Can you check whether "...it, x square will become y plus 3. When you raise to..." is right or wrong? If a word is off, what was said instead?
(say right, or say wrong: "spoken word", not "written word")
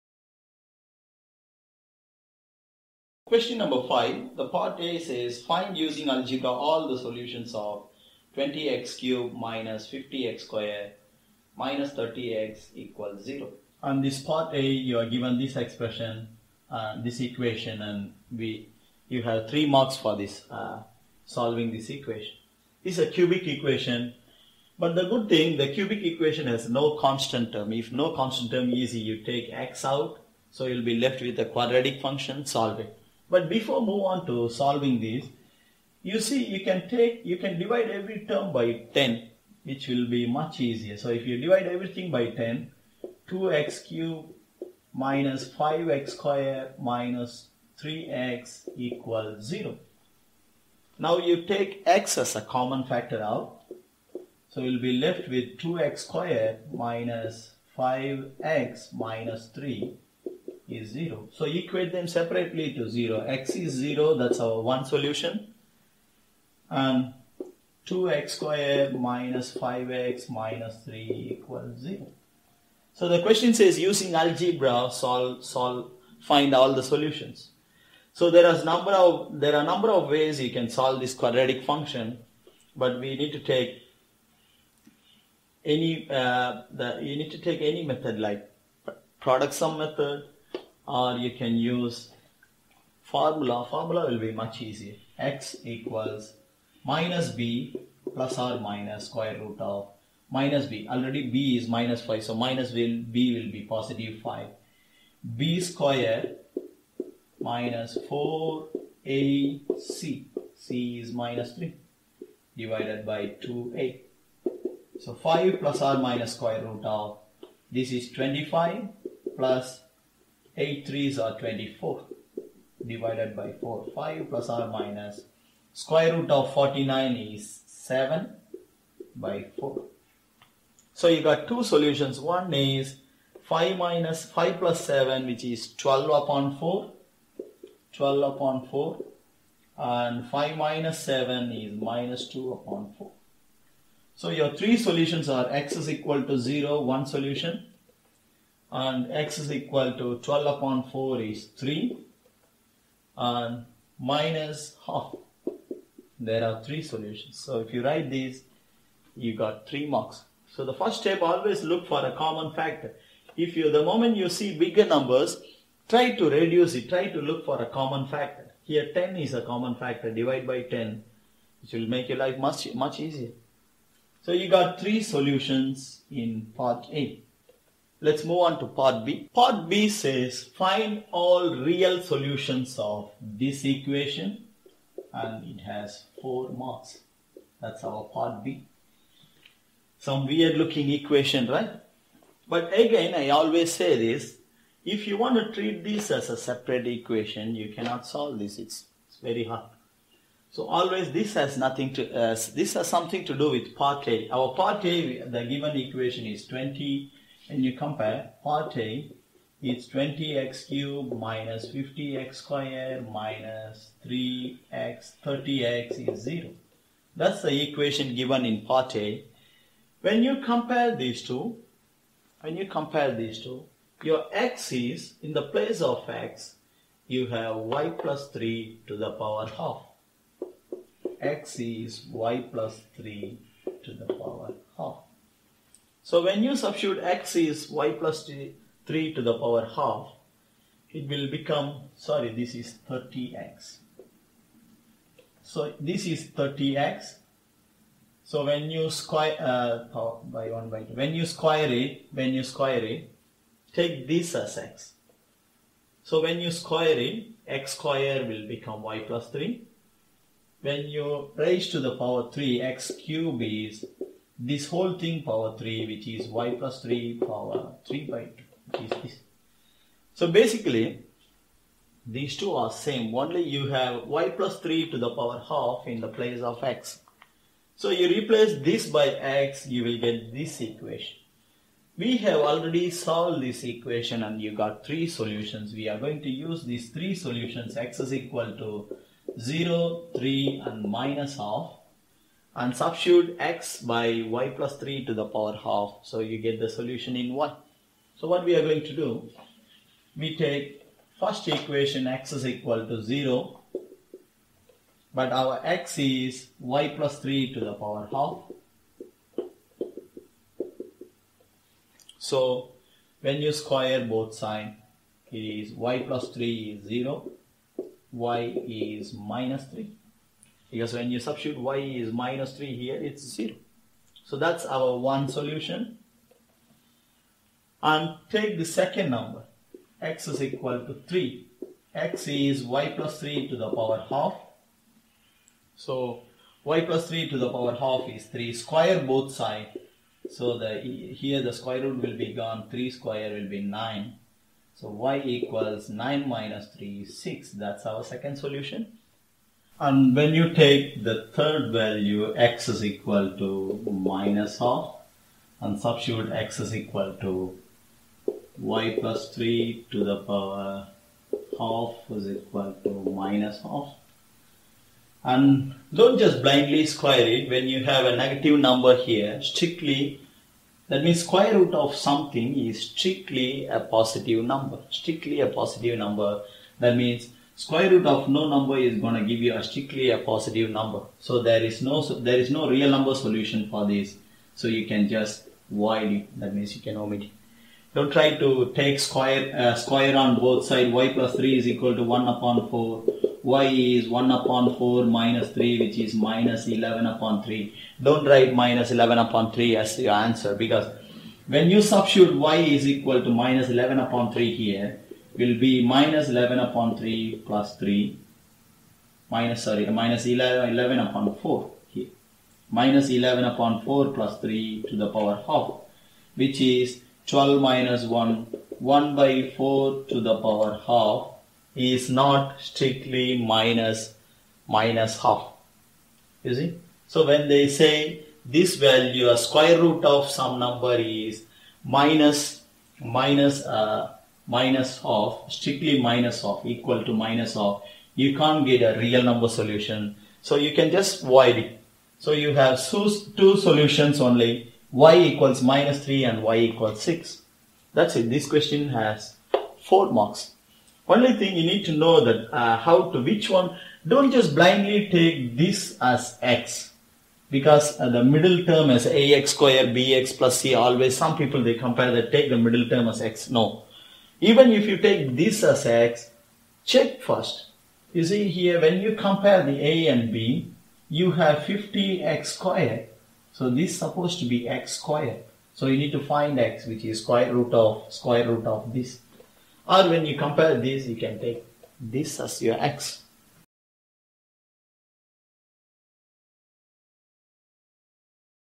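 right.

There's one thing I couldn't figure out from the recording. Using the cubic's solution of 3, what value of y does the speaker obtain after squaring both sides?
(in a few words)
6.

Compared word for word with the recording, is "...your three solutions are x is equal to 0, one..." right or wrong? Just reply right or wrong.
right.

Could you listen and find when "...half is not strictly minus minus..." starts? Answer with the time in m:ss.
7:00.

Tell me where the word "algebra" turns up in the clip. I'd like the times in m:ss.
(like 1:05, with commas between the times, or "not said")
0:06, 1:14.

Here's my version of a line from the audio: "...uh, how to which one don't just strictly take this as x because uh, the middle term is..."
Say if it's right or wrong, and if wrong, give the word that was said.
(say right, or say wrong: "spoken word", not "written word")
wrong: "blindly", not "strictly".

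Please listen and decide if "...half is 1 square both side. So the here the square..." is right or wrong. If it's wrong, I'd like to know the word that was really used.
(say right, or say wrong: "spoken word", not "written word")
wrong: "3", not "1".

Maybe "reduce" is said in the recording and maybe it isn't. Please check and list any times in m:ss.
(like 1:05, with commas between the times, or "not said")
2:46.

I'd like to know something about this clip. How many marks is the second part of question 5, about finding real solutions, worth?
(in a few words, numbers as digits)
4.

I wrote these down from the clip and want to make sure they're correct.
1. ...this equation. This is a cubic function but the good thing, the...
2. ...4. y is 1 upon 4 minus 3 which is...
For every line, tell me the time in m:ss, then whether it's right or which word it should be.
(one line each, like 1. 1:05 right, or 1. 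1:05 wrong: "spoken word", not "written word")
1. 0:21 wrong: "equation", not "function"
2. 6:32 right.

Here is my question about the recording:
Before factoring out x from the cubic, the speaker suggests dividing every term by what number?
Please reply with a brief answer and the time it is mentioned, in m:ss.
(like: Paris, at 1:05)
10, at 0:37.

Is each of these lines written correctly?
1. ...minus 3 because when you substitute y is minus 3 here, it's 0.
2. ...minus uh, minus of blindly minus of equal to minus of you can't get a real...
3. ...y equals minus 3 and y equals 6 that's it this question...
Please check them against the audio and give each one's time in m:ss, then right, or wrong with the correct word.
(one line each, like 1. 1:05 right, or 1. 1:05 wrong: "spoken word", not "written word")
1. 5:19 right
2. 7:12 wrong: "strictly", not "blindly"
3. 7:25 right.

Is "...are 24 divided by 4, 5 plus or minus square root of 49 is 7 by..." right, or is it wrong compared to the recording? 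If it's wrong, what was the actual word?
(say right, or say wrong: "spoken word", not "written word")
right.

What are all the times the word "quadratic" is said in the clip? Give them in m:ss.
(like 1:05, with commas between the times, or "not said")
0:31, 1:21.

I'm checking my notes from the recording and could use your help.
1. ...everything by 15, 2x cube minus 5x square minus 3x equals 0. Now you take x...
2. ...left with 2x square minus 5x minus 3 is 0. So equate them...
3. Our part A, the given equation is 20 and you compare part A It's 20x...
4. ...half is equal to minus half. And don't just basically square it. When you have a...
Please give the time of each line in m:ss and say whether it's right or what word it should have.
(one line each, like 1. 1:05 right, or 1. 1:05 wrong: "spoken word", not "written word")
1. 0:41 wrong: "10", not "15"
2. 0:54 right
3. 3:24 right
4. 6:01 wrong: "blindly", not "basically".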